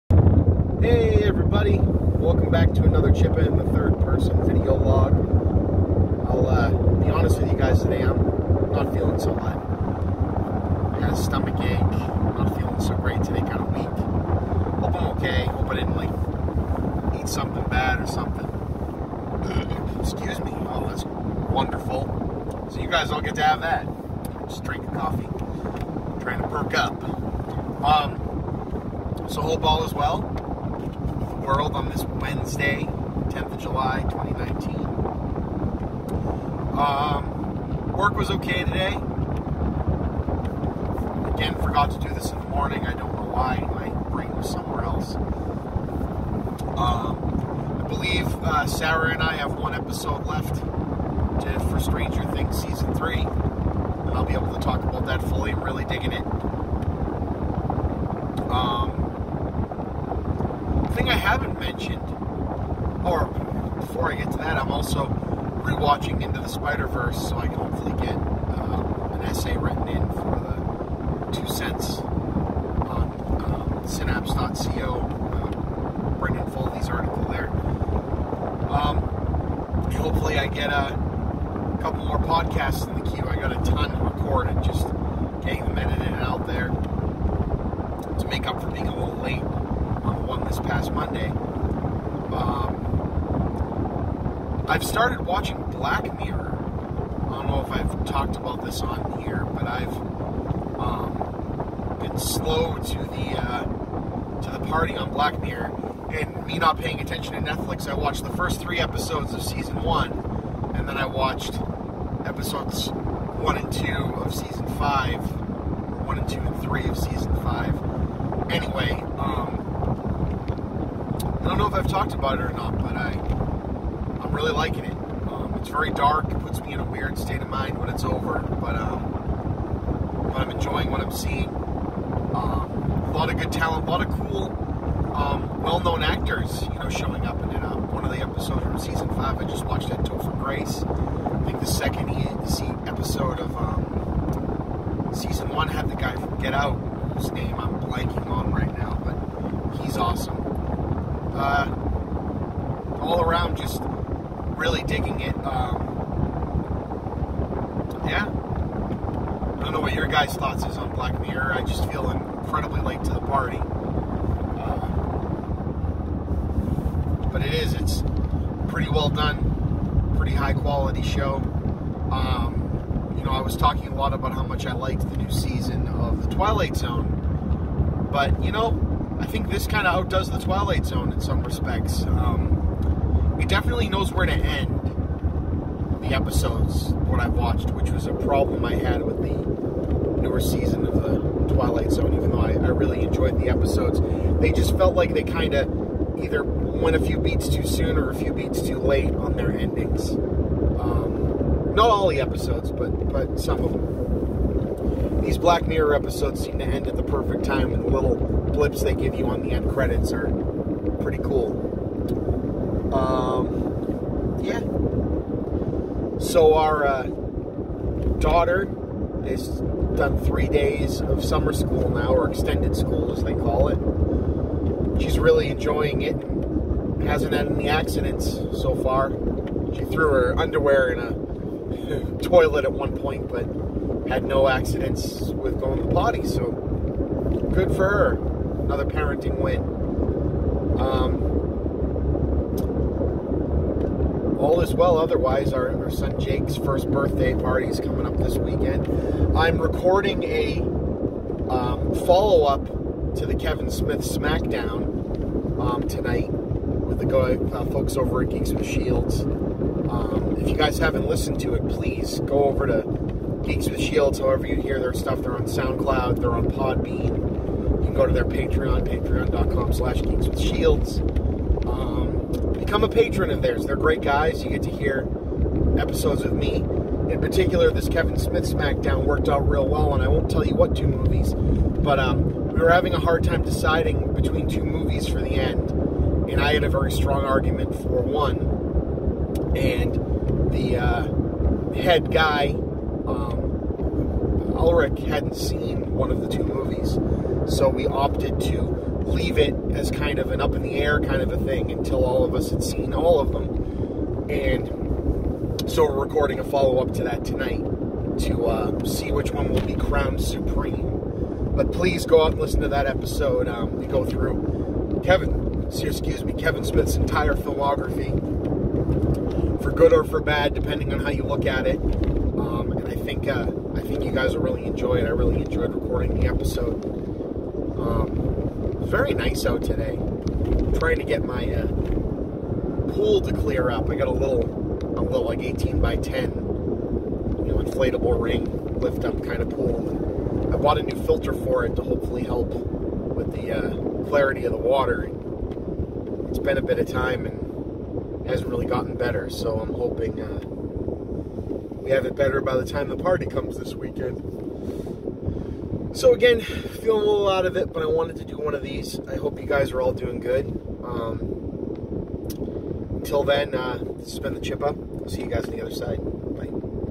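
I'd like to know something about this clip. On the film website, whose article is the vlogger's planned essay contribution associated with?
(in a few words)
Brendan Foley.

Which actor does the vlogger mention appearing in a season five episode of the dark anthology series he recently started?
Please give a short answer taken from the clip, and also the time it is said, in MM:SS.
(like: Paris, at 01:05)
Topher Grace, at 02:19.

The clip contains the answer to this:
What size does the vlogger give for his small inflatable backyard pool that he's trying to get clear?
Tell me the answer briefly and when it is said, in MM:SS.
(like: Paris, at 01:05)
18 by 10, at 05:35.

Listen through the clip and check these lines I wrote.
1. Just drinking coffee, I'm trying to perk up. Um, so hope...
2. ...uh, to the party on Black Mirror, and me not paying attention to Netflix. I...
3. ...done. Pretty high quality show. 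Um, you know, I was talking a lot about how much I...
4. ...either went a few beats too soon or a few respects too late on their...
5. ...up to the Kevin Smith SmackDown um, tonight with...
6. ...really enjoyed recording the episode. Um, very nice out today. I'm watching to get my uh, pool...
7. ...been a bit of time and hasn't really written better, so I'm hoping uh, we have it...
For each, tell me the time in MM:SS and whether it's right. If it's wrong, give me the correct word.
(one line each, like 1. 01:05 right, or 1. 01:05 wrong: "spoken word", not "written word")
1. 00:24 right
2. 01:43 right
3. 02:49 right
4. 03:16 wrong: "beats", not "respects"
5. 04:12 right
6. 05:25 wrong: "trying", not "watching"
7. 05:46 wrong: "gotten", not "written".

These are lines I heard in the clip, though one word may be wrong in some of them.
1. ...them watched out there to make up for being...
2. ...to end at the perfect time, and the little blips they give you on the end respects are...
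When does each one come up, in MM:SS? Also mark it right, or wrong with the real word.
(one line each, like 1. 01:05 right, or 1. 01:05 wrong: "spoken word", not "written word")
1. 01:25 wrong: "edited", not "watched"
2. 03:26 wrong: "credits", not "respects".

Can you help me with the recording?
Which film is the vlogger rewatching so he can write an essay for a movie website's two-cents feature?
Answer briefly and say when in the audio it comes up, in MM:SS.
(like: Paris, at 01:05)
Into the Spider Verse, at 01:06.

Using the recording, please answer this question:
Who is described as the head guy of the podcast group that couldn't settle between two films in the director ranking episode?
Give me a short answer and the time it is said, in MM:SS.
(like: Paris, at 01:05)
Ulrich, at 04:54.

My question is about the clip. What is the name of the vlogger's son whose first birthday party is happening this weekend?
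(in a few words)
Jake.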